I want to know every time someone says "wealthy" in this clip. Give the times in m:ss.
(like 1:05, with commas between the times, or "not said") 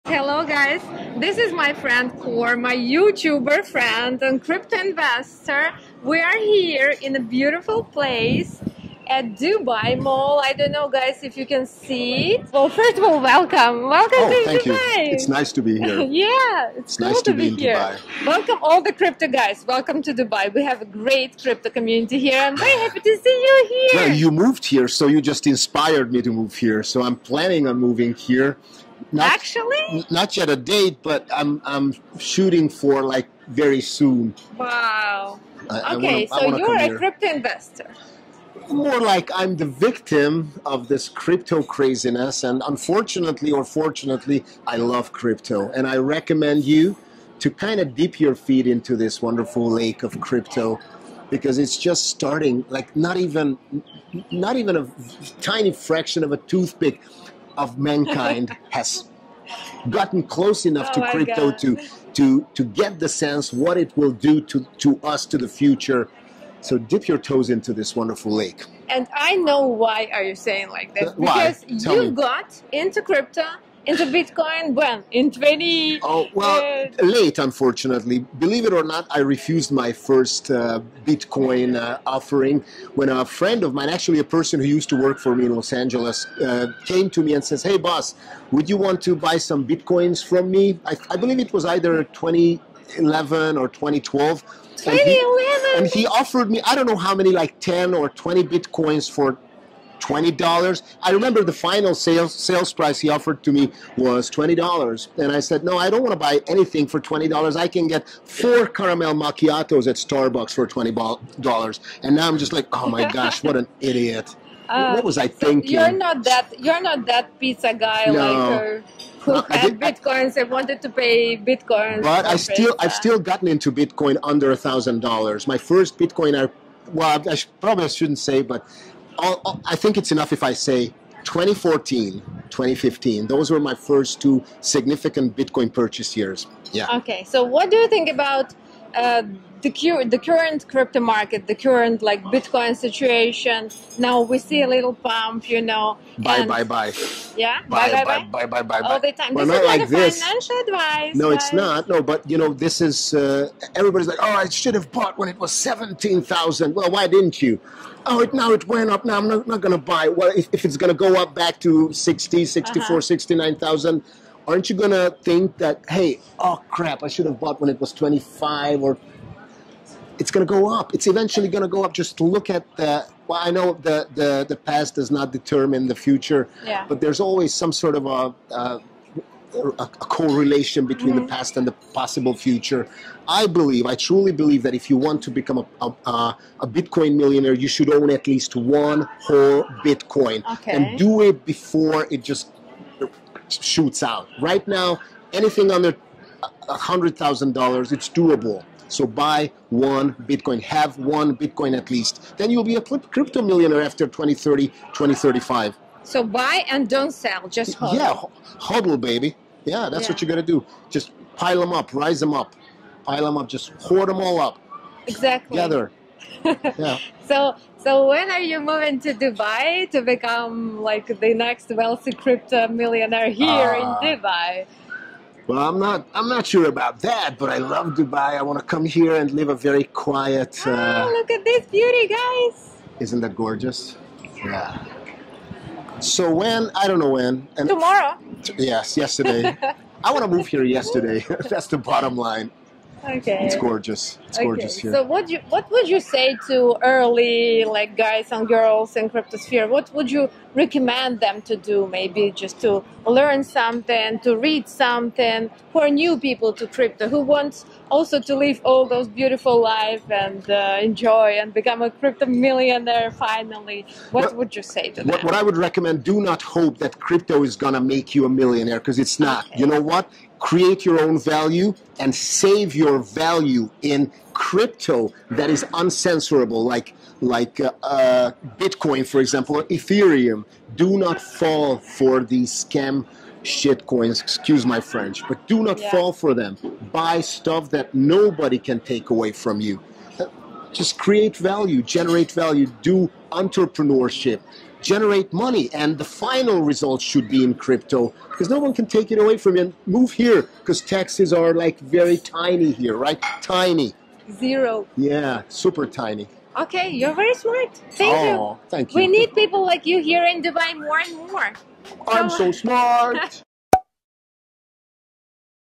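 3:41.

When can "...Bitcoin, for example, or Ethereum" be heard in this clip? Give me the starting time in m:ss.
4:38.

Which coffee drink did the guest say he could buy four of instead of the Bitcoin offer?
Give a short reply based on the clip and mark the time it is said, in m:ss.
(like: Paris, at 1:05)
caramel macchiatos, at 1:48.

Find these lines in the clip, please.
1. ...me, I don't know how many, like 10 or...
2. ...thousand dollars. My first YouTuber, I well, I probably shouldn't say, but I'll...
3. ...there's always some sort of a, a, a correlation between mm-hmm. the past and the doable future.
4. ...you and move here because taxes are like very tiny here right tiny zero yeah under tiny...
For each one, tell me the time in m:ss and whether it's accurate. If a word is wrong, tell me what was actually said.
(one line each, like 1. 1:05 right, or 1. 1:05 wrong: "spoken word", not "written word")
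1. 1:36 right
2. 2:04 wrong: "Bitcoin", not "YouTuber"
3. 2:57 wrong: "possible", not "doable"
4. 4:59 wrong: "super", not "under".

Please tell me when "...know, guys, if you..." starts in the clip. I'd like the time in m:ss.
0:10.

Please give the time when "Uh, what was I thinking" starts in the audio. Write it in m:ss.
1:54.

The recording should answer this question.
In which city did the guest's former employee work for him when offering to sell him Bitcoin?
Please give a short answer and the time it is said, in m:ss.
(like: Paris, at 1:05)
Los Angeles, at 1:25.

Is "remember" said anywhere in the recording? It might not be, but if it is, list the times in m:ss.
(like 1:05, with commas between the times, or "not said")
1:41.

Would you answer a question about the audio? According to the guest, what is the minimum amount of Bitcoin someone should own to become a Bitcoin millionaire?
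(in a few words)
one whole Bitcoin.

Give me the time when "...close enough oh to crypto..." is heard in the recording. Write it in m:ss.
1:00.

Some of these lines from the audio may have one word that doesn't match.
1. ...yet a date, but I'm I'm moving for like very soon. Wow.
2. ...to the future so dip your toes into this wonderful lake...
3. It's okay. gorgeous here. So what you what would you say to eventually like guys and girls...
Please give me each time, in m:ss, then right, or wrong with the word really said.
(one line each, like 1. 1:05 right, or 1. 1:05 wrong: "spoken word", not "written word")
1. 0:30 wrong: "shooting", not "moving"
2. 1:05 right
3. 4:04 wrong: "early", not "eventually".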